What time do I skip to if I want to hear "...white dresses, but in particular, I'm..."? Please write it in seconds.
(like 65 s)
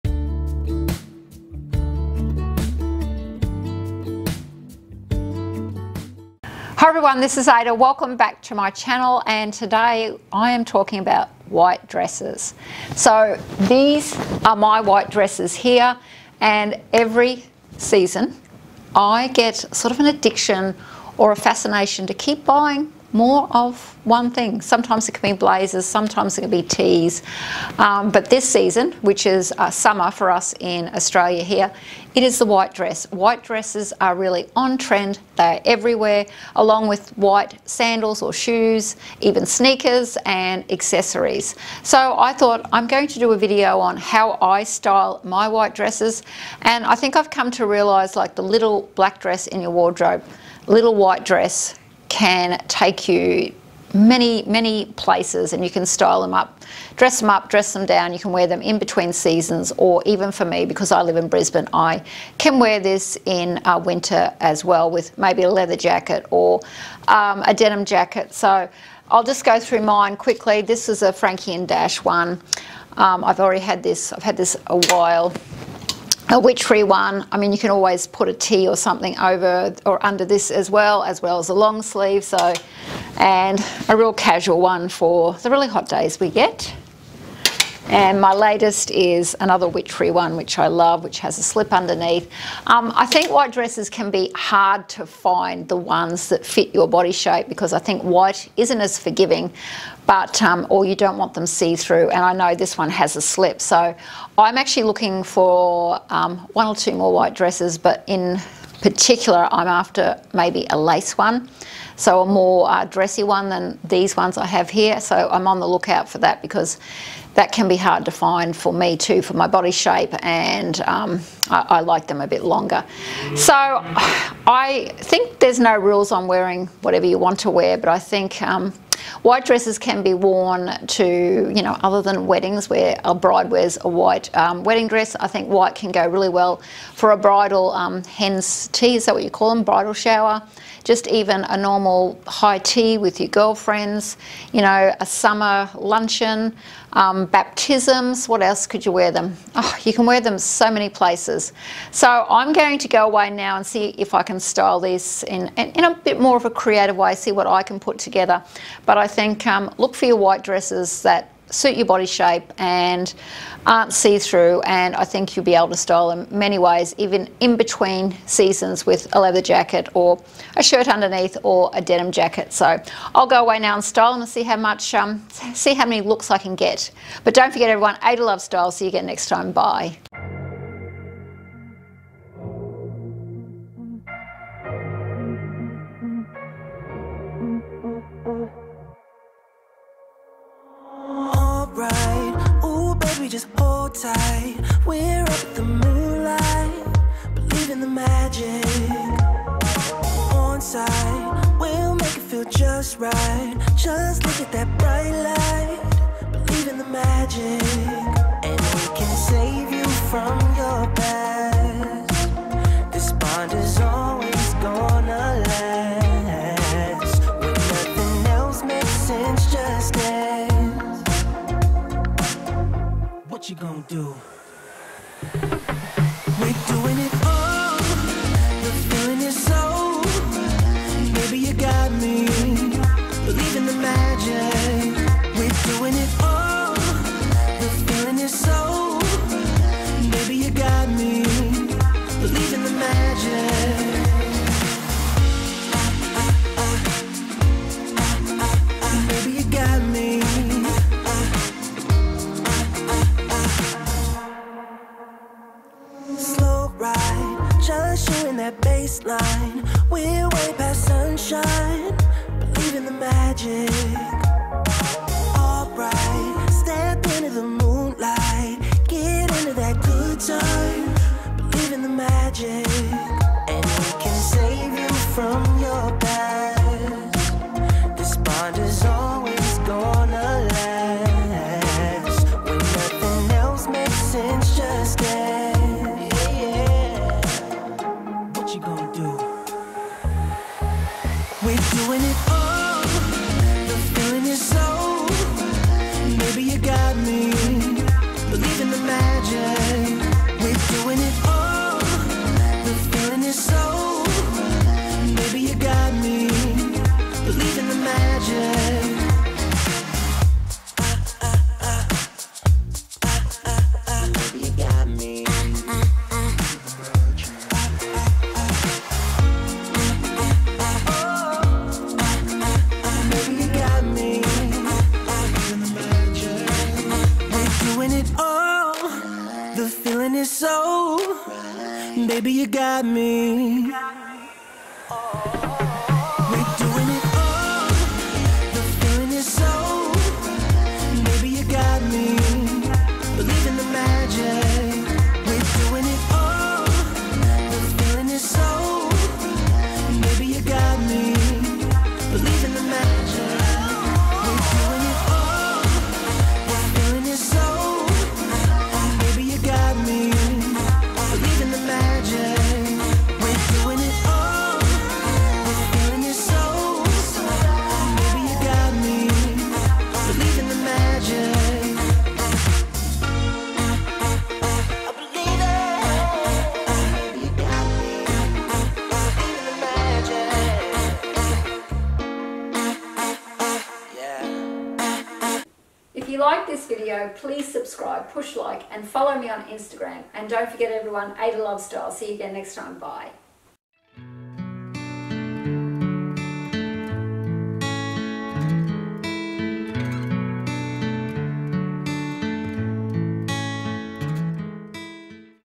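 107 s.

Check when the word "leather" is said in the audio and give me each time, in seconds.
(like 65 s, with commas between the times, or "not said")
65 s, 169 s.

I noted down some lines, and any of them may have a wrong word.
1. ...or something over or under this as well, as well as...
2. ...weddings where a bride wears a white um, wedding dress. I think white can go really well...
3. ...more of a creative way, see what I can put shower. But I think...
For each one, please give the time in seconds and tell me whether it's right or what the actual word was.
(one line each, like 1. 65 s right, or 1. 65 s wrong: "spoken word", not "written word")
1. 78 s right
2. 132 s right
3. 156 s wrong: "together", not "shower".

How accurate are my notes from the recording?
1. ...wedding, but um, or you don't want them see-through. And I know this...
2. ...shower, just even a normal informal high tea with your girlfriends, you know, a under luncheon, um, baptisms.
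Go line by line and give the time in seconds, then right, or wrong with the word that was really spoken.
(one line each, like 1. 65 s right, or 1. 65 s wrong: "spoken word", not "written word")
1. 98 s wrong: "forgiving", not "wedding"
2. 139 s wrong: "summer", not "under".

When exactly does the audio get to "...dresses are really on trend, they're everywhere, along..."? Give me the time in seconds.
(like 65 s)
33 s.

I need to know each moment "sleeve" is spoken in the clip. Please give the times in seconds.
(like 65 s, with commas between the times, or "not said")
81 s.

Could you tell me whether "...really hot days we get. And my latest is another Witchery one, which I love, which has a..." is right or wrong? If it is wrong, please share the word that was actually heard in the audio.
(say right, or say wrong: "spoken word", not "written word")
right.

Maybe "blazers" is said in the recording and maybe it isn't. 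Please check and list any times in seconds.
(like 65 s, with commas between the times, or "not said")
25 s.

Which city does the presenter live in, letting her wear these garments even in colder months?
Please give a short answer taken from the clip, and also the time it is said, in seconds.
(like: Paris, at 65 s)
Brisbane, at 61 s.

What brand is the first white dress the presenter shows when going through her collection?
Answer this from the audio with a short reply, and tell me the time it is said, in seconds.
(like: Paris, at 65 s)
Frankie and Dash, at 71 s.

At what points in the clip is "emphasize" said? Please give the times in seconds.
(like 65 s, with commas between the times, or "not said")
not said.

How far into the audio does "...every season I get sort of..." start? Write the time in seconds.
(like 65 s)
16 s.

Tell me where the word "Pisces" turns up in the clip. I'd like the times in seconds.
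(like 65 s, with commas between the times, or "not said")
not said.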